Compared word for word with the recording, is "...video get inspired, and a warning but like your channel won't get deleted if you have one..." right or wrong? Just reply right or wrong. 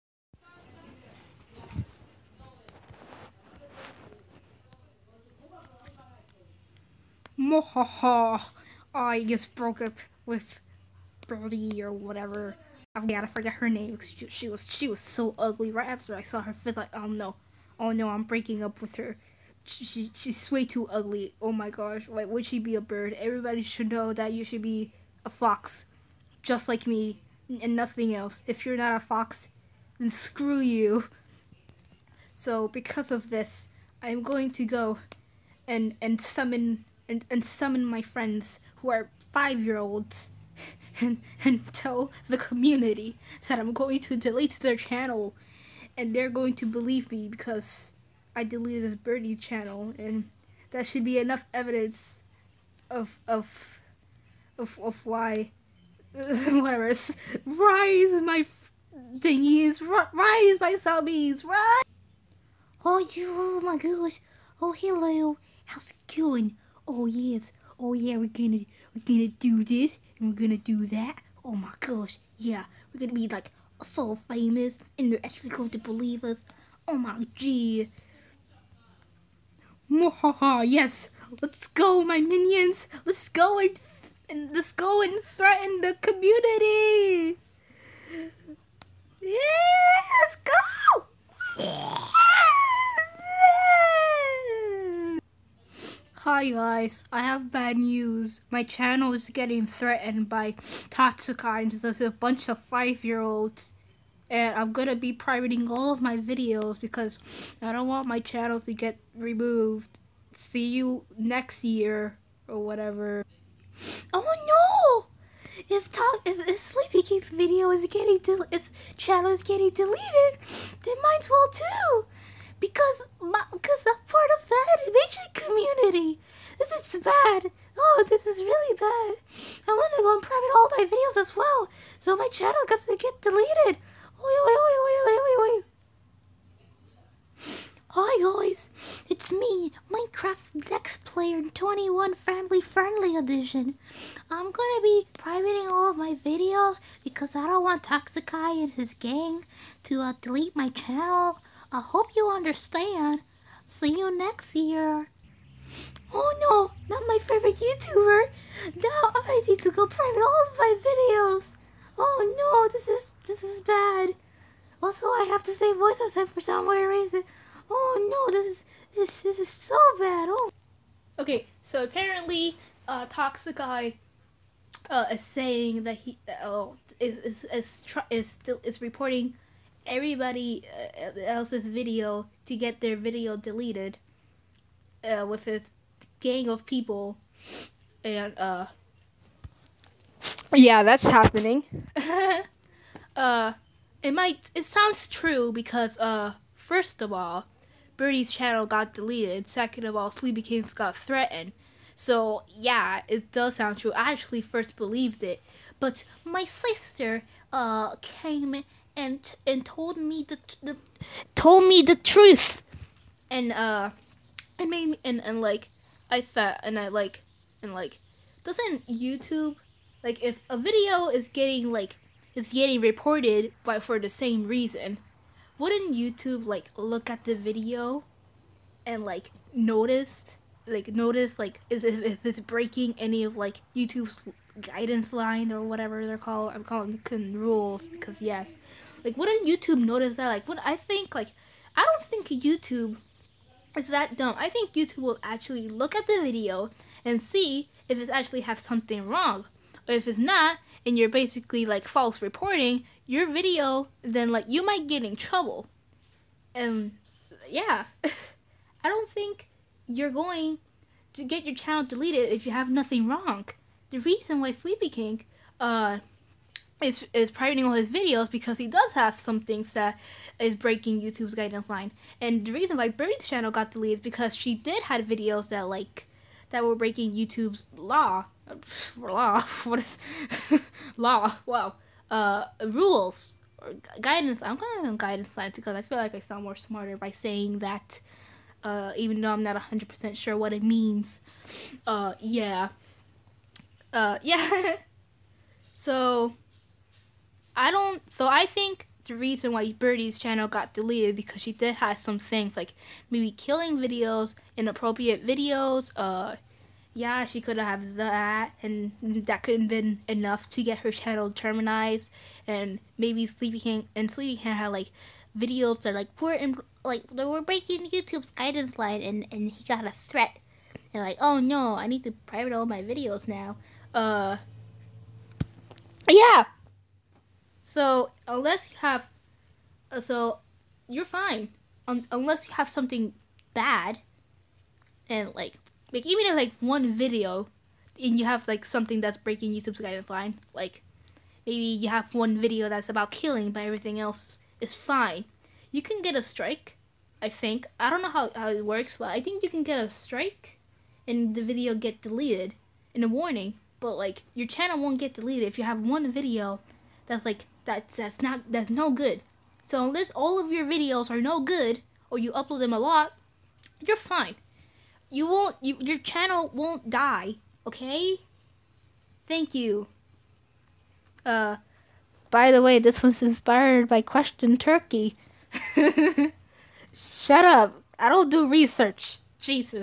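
wrong.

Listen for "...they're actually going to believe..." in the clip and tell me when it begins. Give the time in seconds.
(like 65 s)
75 s.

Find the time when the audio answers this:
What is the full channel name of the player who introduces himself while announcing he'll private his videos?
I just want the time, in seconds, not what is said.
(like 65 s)
139 s.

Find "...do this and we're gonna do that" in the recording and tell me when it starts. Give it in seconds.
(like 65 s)
69 s.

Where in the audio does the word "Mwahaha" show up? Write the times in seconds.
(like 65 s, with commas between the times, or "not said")
7 s, 79 s.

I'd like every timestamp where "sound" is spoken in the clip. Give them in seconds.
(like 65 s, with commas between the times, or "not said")
194 s, 203 s, 286 s.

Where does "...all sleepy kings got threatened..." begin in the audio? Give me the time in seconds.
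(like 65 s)
199 s.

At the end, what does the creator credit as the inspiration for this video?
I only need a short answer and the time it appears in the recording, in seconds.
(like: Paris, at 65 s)
Question Turkey, at 374 s.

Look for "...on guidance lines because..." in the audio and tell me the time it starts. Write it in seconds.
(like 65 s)
284 s.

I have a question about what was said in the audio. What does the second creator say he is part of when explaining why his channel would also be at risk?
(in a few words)
The Matrix community.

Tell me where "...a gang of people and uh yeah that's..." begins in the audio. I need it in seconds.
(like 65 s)
185 s.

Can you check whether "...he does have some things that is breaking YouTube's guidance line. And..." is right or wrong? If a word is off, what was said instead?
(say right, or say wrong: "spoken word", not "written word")
right.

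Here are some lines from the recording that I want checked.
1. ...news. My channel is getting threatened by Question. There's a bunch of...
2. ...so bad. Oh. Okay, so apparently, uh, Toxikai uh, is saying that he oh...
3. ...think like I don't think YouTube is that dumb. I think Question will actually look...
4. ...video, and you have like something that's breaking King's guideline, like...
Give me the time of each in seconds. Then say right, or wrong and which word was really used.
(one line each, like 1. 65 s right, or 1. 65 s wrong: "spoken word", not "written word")
1. 97 s wrong: "Toxikines", not "Question"
2. 169 s right
3. 240 s wrong: "YouTube", not "Question"
4. 336 s wrong: "YouTube", not "King".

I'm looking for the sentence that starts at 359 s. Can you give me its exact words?
So unless all of your videos are no good or you upload them a lot, you're fine.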